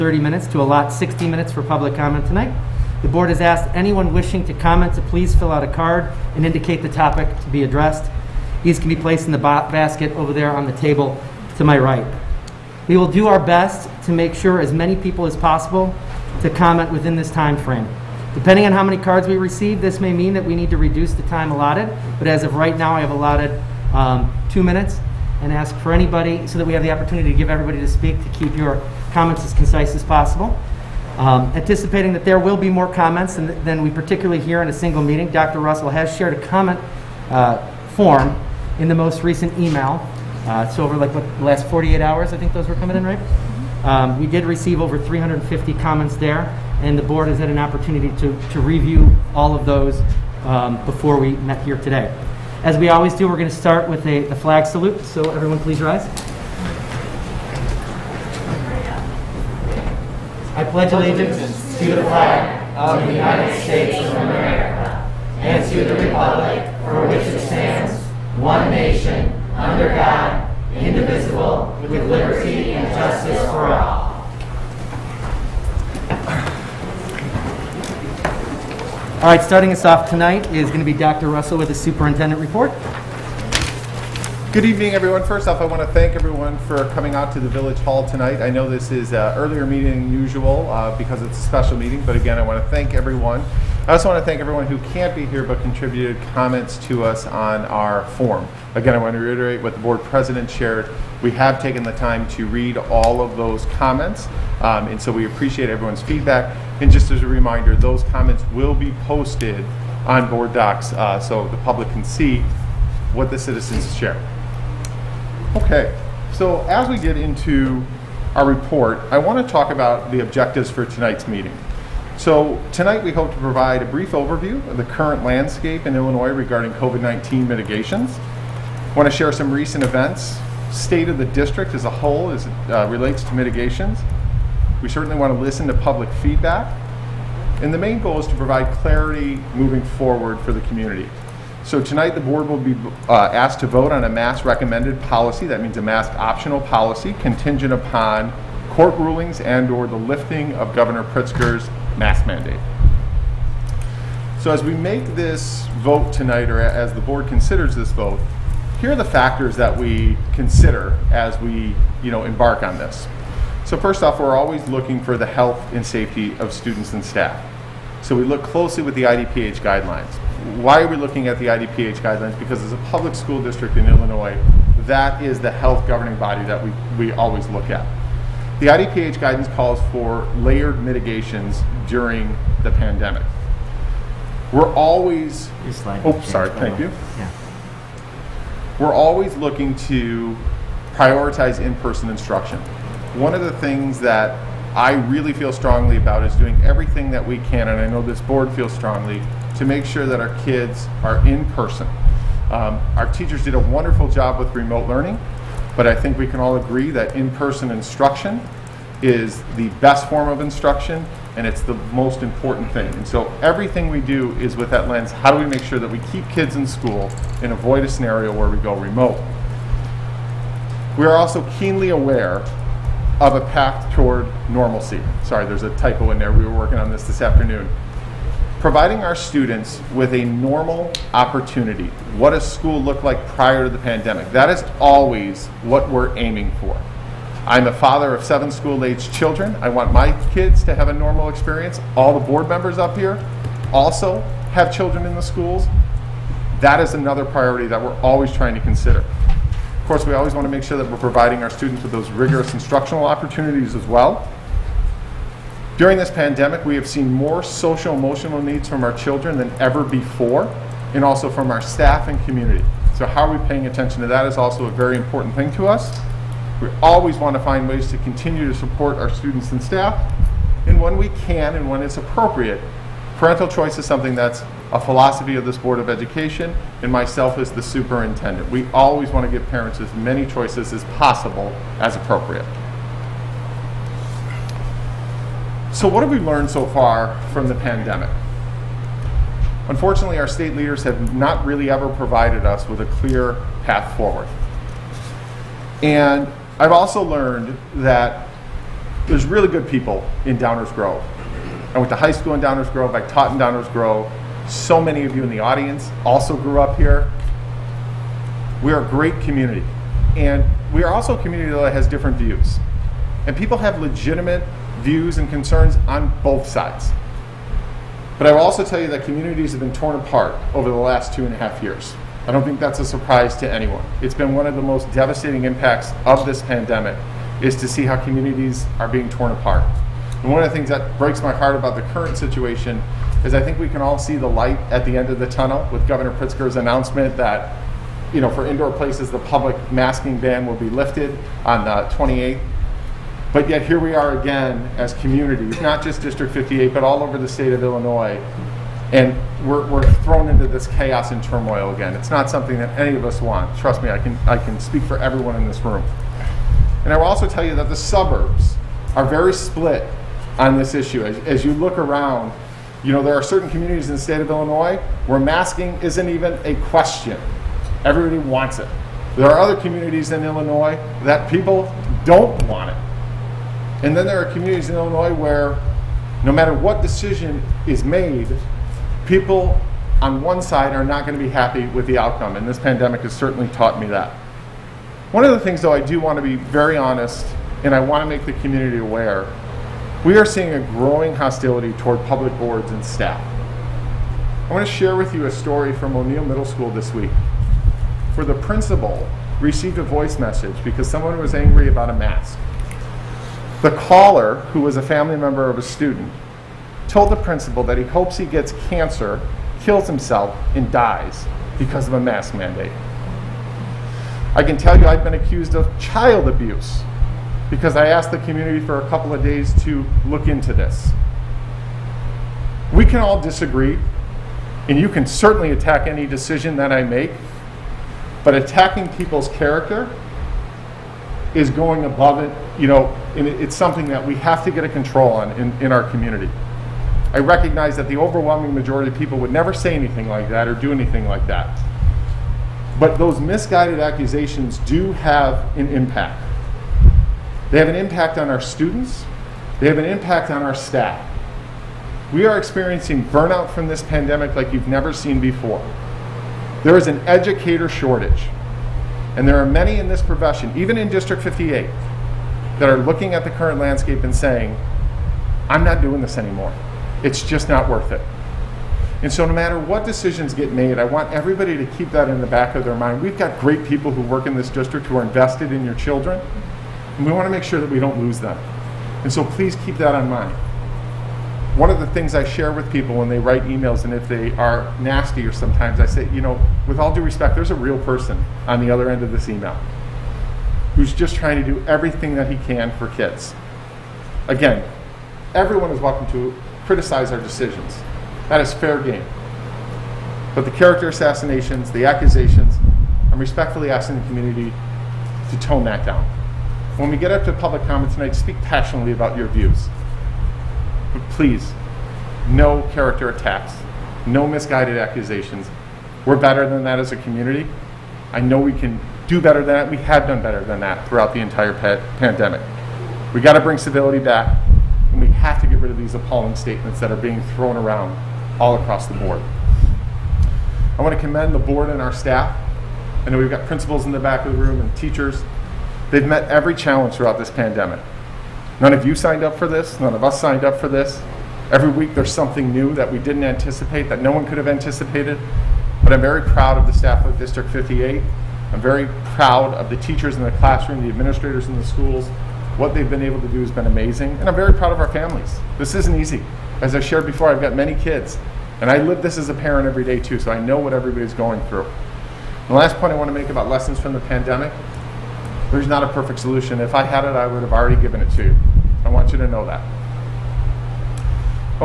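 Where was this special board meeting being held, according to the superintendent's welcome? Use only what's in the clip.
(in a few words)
Village Hall.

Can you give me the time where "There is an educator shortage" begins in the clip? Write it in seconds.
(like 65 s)
456 s.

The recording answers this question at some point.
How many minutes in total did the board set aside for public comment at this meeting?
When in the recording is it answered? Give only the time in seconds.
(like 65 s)
0 s.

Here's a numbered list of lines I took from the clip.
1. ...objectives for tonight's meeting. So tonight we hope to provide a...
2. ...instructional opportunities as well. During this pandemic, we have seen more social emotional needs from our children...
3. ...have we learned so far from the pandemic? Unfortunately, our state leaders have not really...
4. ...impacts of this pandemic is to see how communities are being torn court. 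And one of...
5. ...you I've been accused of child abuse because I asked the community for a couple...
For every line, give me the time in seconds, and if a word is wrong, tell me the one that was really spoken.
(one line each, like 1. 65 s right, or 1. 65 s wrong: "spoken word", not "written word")
1. 120 s right
2. 252 s right
3. 286 s right
4. 325 s wrong: "apart", not "court"
5. 414 s right.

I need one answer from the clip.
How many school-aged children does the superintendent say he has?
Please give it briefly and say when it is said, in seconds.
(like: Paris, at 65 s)
7, at 238 s.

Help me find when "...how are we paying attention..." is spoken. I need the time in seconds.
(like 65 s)
263 s.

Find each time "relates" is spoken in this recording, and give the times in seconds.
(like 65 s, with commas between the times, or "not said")
132 s.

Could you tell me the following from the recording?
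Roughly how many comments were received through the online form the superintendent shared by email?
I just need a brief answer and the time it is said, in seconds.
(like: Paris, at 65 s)
over 350, at 44 s.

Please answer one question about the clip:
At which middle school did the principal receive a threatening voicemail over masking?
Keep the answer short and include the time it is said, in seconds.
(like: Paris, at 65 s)
O'Neill Middle School, at 395 s.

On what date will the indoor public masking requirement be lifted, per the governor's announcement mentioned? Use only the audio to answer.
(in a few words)
the 28th.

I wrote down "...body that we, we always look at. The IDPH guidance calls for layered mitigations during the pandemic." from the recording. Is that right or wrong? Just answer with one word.
right.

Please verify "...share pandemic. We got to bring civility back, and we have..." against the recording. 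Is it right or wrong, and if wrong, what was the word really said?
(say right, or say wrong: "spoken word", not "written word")
wrong: "entire", not "share".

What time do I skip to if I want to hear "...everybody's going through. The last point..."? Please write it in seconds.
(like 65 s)
560 s.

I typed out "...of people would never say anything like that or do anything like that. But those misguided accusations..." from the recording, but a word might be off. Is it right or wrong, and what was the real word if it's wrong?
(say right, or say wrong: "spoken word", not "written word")
right.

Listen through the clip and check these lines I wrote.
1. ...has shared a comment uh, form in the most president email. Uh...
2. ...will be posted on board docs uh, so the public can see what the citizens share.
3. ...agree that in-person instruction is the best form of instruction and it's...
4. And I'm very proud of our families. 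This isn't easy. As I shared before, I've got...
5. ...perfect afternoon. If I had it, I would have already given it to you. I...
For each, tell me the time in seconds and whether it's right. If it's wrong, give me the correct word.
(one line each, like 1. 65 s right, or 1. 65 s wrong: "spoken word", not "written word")
1. 35 s wrong: "recent", not "president"
2. 108 s right
3. 206 s right
4. 554 s right
5. 565 s wrong: "solution", not "afternoon".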